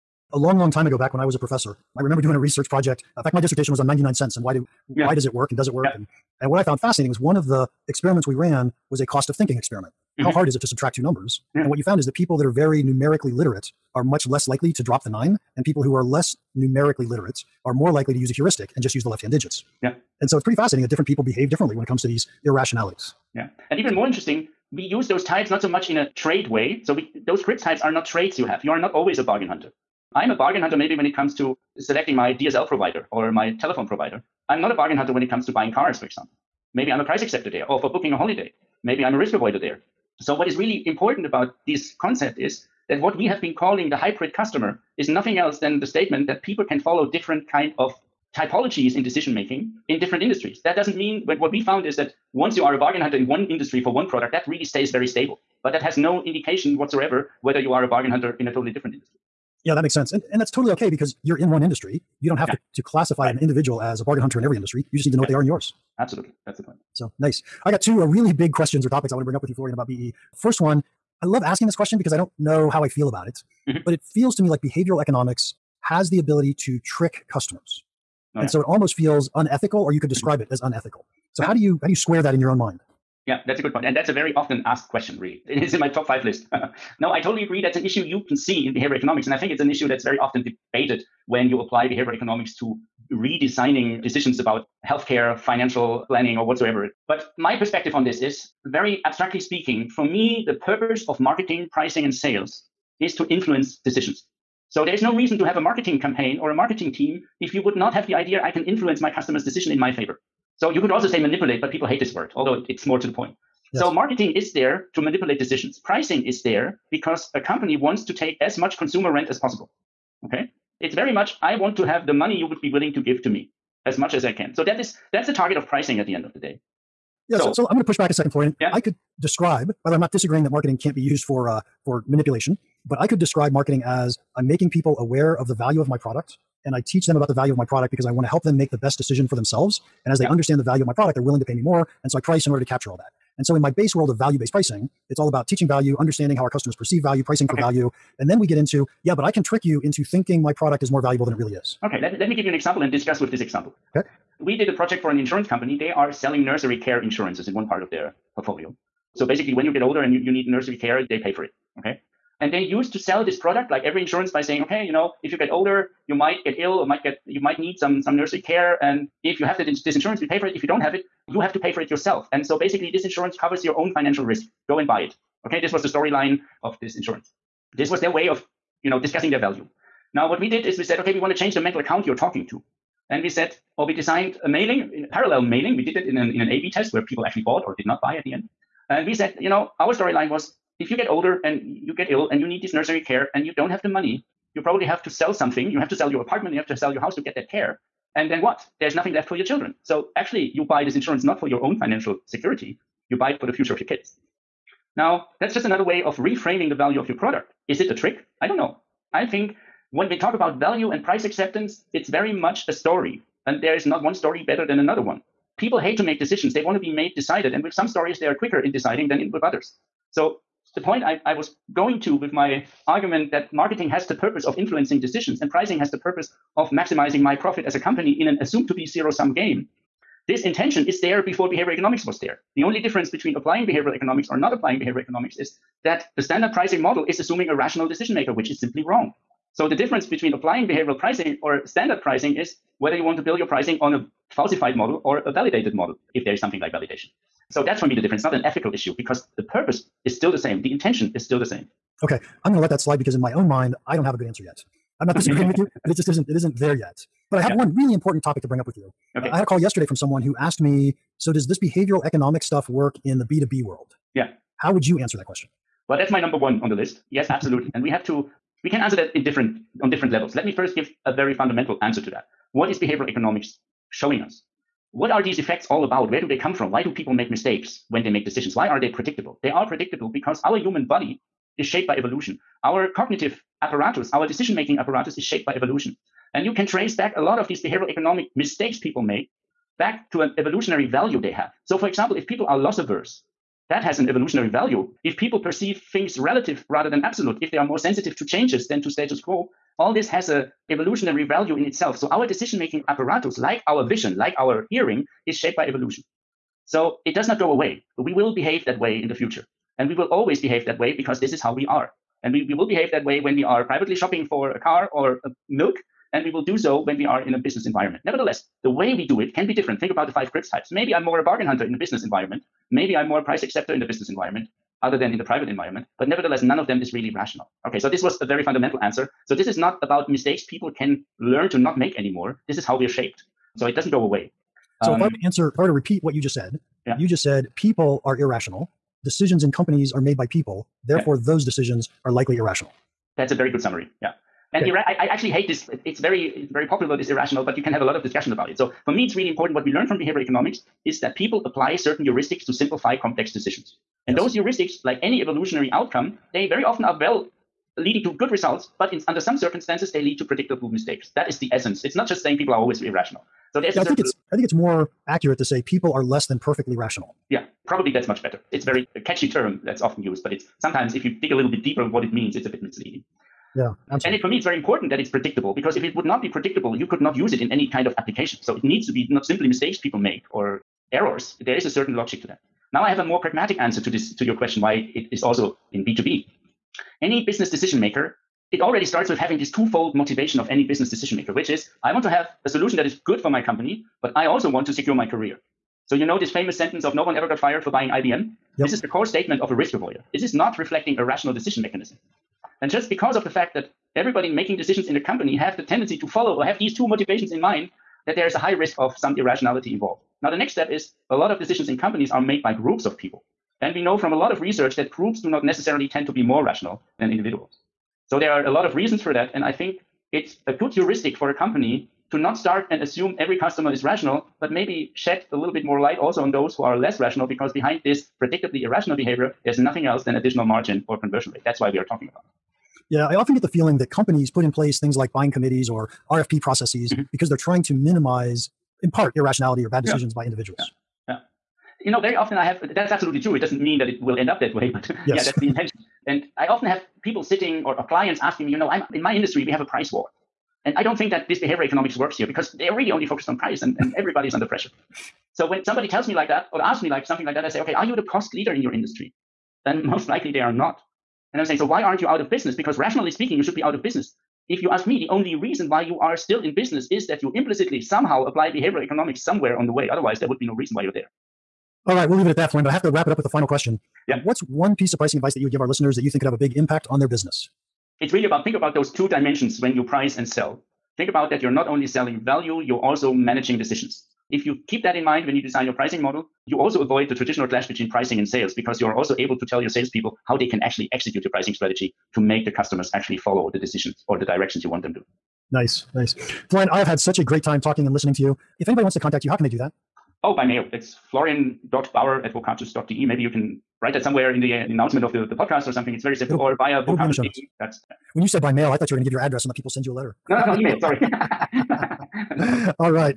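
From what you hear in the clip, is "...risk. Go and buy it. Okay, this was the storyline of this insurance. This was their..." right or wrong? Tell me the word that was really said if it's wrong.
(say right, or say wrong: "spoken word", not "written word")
right.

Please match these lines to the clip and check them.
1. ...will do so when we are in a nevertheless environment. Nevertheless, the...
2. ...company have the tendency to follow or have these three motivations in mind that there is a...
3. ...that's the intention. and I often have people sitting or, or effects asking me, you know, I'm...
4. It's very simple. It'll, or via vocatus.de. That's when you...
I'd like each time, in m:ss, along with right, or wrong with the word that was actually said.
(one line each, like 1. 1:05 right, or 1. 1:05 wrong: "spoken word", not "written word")
1. 5:16 wrong: "business", not "nevertheless"
2. 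6:44 wrong: "two", not "three"
3. 7:25 wrong: "clients", not "effects"
4. 8:25 right.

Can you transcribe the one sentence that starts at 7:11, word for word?
That's why we are talking about.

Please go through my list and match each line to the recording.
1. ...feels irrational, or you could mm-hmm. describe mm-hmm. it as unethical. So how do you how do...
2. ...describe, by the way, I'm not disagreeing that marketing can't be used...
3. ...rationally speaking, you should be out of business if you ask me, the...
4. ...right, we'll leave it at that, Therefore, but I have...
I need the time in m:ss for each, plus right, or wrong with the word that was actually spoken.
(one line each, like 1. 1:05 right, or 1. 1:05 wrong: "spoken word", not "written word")
1. 1:18 wrong: "unethical", not "irrational"
2. 2:09 right
3. 7:42 right
4. 7:51 wrong: "Florian", not "Therefore".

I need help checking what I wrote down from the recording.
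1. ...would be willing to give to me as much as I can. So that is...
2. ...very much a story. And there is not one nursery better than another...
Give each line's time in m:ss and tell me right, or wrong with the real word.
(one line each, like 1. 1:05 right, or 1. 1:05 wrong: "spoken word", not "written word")
1. 2:02 right
2. 3:32 wrong: "story", not "nursery".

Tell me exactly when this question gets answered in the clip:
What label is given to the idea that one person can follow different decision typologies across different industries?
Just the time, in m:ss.
0:43.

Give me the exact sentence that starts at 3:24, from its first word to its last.
Now, that's just another way of reframing the value of your product.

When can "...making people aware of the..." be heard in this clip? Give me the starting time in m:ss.
2:14.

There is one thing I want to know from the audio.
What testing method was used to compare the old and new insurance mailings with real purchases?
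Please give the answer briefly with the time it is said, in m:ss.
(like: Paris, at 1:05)
A-B test, at 3:06.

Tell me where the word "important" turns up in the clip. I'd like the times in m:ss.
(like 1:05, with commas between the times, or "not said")
0:40, 4:17, 5:49, 6:14.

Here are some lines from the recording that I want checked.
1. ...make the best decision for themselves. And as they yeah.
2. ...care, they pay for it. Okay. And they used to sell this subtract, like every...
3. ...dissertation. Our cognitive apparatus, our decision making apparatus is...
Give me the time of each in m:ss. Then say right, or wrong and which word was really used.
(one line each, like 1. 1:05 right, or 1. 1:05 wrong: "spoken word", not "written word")
1. 2:18 right
2. 2:40 wrong: "product", not "subtract"
3. 4:41 wrong: "evolution", not "dissertation".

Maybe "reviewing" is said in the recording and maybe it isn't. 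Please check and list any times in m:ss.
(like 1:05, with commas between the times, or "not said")
not said.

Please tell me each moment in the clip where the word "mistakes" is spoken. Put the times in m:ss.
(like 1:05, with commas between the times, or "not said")
4:37, 4:48, 5:30, 6:00, 6:19.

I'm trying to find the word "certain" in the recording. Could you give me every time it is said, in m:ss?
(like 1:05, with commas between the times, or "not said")
5:51, 6:21.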